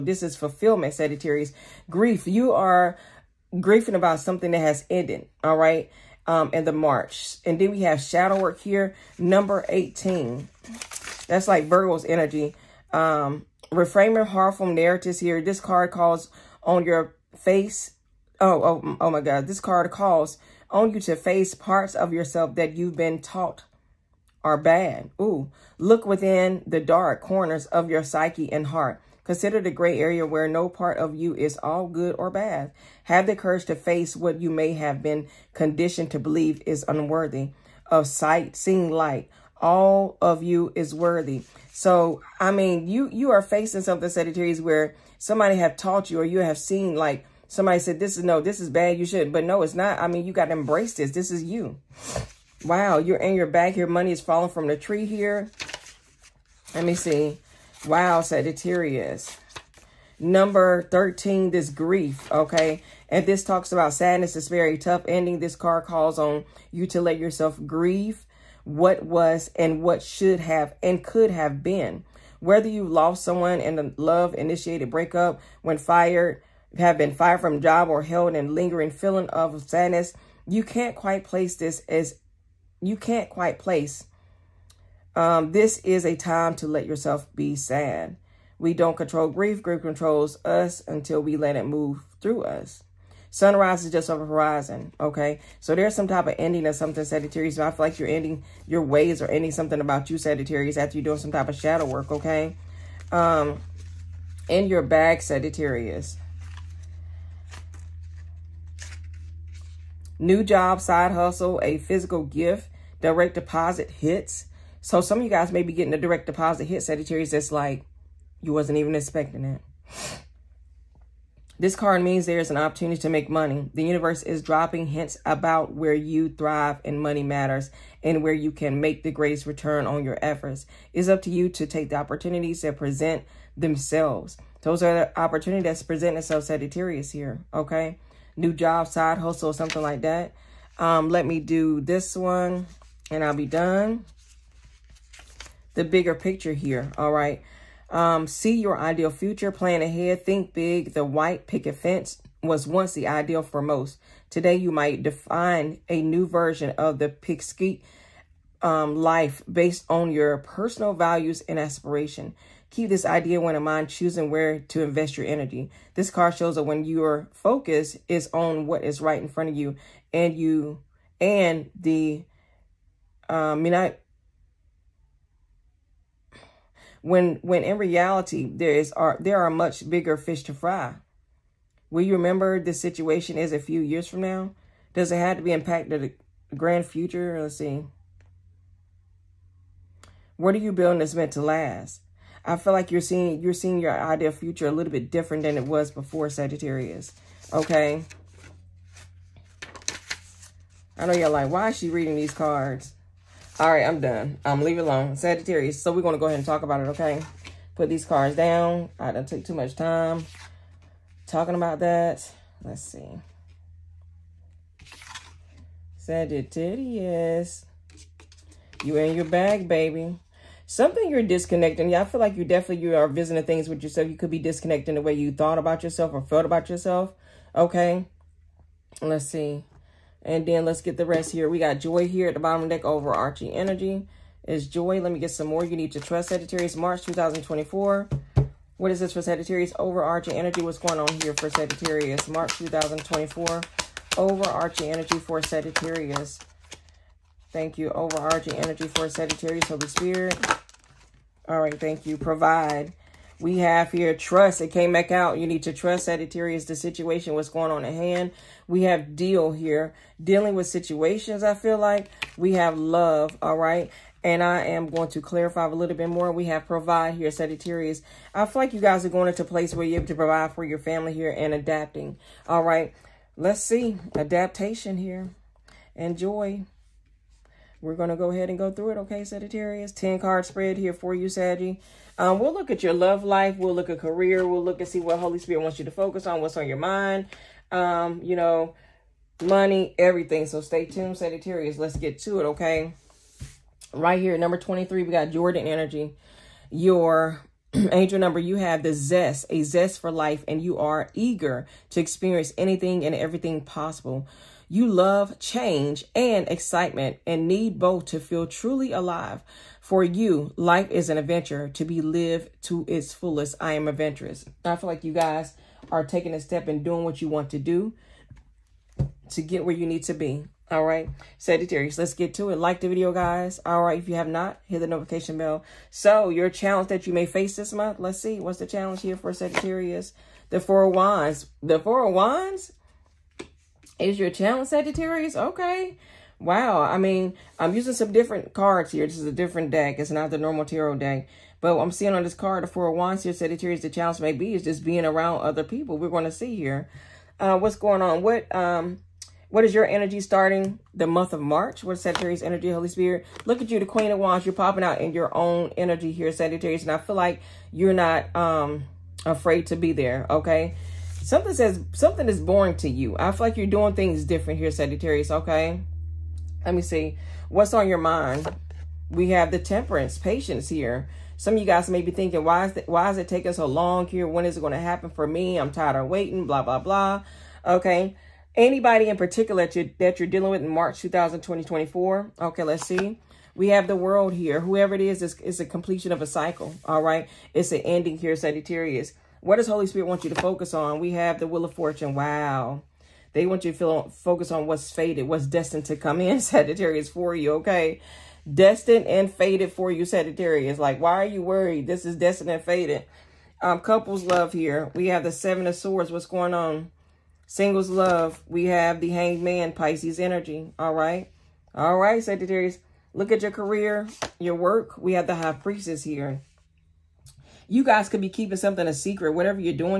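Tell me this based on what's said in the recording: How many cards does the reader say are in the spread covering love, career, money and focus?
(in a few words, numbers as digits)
10.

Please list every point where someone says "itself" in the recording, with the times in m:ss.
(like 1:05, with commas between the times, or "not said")
2:16.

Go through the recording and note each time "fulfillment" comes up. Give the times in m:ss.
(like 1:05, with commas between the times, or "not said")
0:00.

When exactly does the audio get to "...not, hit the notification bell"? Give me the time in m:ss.
5:24.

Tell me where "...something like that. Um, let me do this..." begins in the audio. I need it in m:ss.
2:19.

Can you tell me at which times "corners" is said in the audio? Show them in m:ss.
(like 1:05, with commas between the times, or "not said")
0:27.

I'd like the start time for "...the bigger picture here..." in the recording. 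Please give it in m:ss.
2:25.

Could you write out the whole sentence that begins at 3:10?
What are you building that's meant to last?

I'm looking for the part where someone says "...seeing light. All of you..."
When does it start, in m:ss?
0:38.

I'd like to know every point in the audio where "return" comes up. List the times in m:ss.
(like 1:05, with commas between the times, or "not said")
2:09.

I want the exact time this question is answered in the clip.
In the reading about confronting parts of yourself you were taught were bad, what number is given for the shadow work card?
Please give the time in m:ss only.
0:09.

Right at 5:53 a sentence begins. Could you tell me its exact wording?
Look at you, the Queen of Wands.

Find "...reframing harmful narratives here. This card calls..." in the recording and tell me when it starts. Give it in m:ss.
0:13.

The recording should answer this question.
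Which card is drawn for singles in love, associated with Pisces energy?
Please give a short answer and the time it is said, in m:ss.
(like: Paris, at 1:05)
The Hanged Man, at 6:48.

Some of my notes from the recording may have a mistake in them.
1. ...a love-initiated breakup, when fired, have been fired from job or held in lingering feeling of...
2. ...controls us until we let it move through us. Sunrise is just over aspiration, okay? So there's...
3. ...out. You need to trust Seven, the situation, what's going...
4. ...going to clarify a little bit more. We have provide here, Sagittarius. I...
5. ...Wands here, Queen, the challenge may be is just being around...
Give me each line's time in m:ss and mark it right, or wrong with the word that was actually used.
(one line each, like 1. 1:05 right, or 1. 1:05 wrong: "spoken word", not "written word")
1. 1:13 right
2. 1:29 wrong: "horizon", not "aspiration"
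3. 4:15 wrong: "Sagittarius", not "Seven"
4. 4:24 right
5. 5:42 wrong: "Sagittarius", not "Queen".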